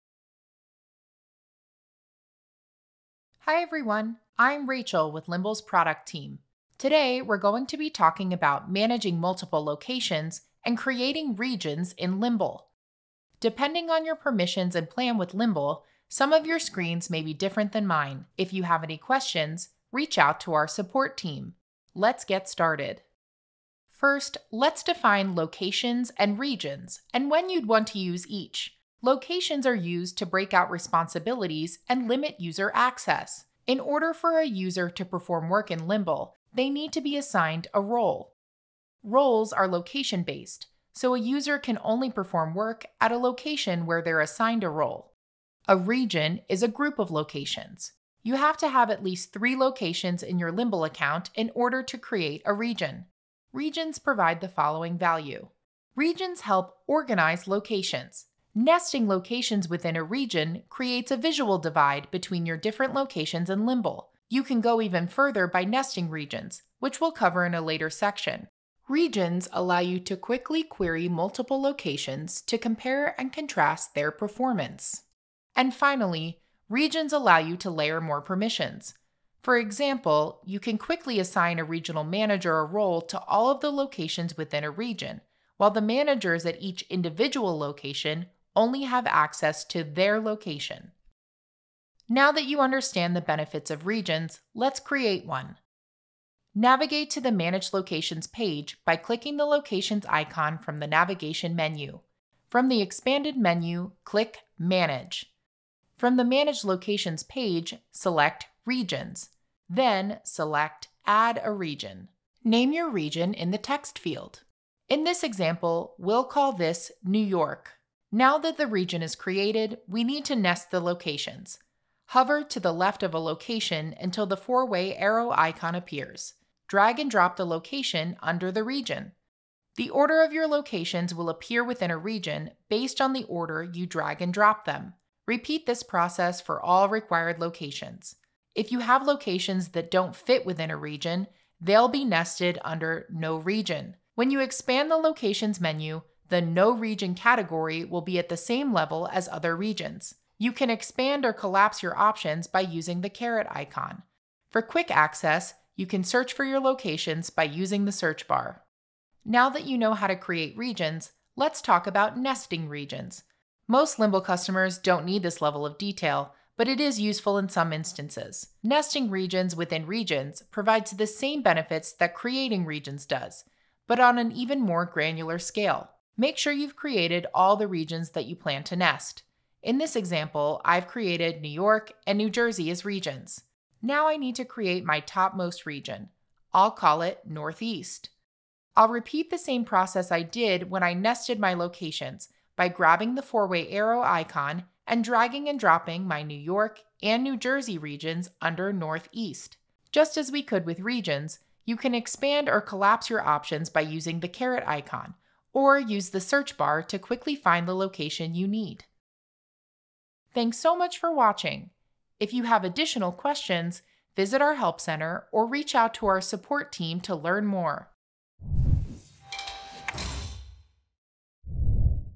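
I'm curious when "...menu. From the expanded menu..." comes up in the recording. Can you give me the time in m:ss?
1:41.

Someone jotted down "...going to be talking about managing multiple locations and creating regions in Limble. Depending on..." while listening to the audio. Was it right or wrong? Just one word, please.
right.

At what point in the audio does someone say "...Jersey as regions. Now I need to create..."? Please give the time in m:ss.
3:02.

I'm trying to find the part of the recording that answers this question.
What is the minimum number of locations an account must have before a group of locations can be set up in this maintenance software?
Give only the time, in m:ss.
0:49.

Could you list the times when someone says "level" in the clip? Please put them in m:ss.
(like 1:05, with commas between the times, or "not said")
2:28, 2:45.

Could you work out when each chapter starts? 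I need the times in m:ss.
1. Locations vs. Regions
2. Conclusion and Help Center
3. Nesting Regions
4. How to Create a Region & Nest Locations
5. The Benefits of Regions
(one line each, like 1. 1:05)
1. 0:23
2. 3:30
3. 2:39
4. 1:31
5. 0:53.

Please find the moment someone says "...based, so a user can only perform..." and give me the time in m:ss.
0:40.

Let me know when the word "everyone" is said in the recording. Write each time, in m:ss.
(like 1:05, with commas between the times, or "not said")
0:03.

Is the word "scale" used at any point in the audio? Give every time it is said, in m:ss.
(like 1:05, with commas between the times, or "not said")
2:55.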